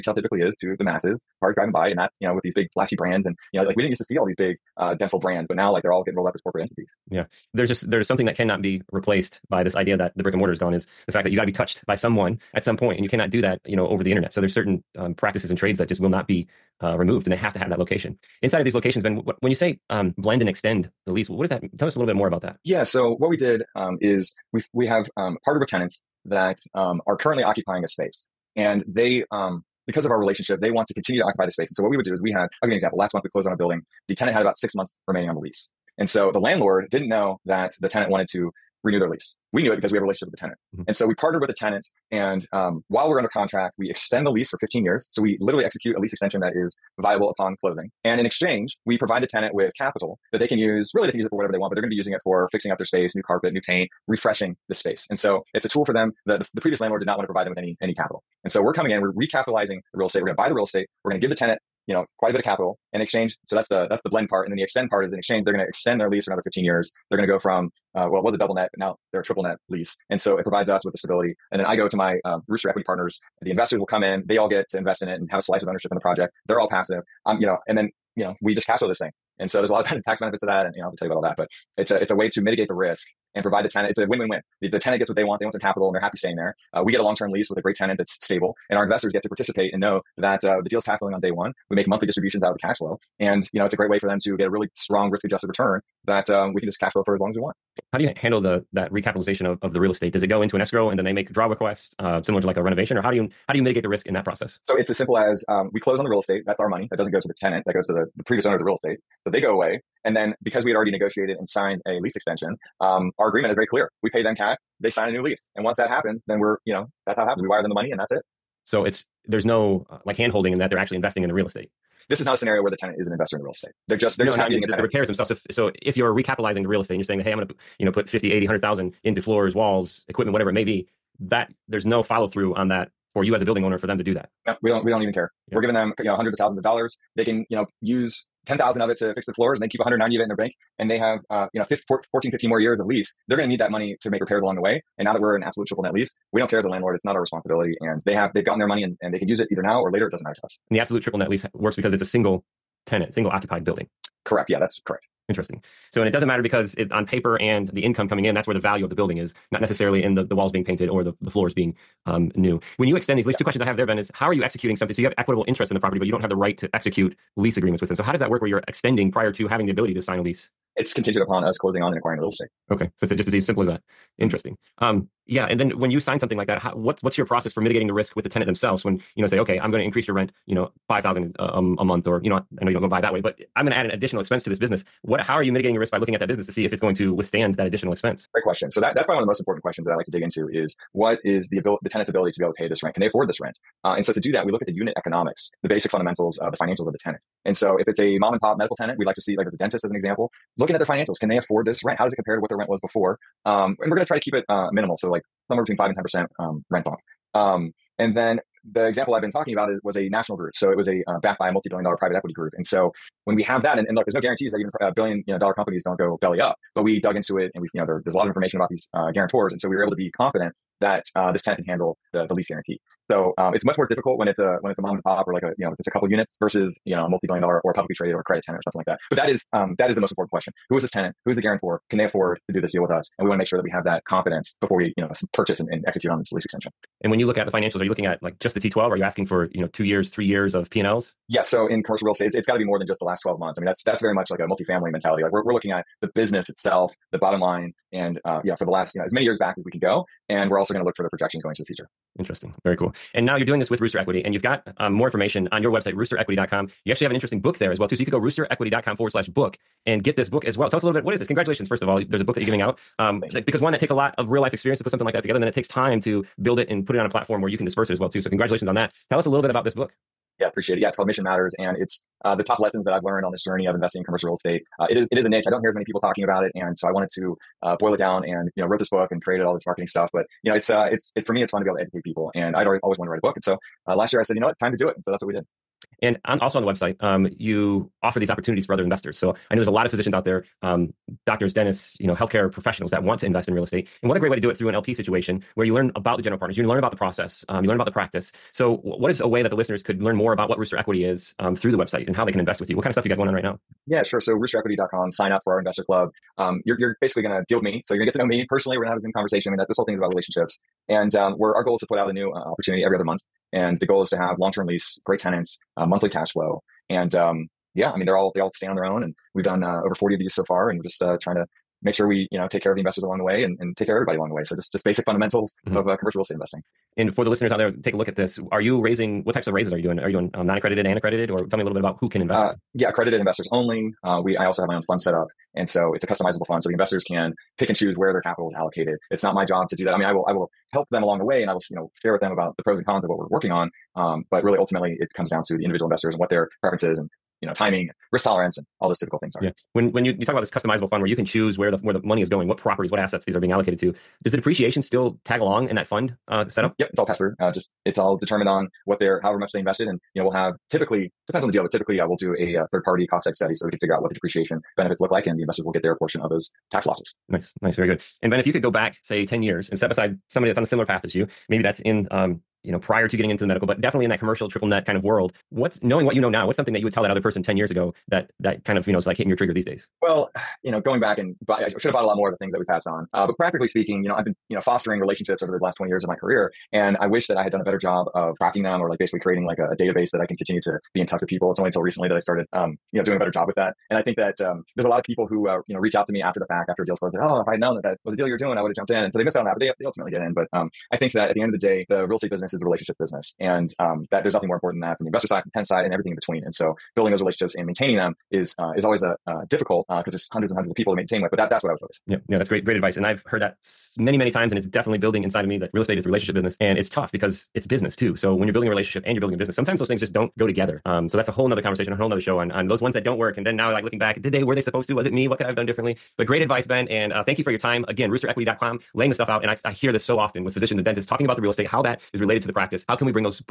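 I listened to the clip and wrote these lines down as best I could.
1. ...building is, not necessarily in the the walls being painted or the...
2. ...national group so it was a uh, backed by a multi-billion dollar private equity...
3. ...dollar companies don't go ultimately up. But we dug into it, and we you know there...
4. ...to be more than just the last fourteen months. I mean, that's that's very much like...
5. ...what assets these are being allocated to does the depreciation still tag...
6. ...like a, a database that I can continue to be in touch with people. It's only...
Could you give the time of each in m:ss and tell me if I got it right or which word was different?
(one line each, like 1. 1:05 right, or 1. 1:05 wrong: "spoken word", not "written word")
1. 2:38 right
2. 3:30 right
3. 3:35 wrong: "belly", not "ultimately"
4. 4:02 wrong: "twelve", not "fourteen"
5. 5:52 right
6. 6:29 right.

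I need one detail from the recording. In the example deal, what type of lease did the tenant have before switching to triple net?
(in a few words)
double net.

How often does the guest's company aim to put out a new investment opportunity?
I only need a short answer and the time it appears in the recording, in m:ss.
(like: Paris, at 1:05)
every other month, at 5:12.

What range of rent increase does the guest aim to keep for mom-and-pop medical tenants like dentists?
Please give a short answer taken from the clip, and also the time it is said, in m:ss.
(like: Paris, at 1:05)
5 to 10%, at 3:25.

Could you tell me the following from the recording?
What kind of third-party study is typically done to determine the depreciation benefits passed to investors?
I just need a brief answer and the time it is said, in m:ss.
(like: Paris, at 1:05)
cost seg study, at 6:03.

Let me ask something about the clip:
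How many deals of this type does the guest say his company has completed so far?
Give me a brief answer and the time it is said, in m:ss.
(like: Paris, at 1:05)
over 40, at 5:19.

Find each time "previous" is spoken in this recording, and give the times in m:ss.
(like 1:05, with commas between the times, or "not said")
0:56, 1:48.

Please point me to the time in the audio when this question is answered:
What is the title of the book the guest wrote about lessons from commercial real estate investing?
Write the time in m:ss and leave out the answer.
4:31.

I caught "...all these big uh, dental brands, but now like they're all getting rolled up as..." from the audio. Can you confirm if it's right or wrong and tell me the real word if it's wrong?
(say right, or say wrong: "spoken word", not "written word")
right.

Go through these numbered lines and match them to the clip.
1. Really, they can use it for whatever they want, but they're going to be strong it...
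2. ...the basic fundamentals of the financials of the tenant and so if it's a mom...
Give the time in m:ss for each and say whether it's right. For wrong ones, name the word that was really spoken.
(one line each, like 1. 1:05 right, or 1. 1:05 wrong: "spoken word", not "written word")
1. 0:50 wrong: "using", not "strong"
2. 3:15 right.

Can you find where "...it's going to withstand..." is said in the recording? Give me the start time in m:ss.
3:06.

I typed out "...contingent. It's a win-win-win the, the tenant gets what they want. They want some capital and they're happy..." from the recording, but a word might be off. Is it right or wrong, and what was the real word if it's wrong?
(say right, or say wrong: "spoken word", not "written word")
wrong: "tenant", not "contingent".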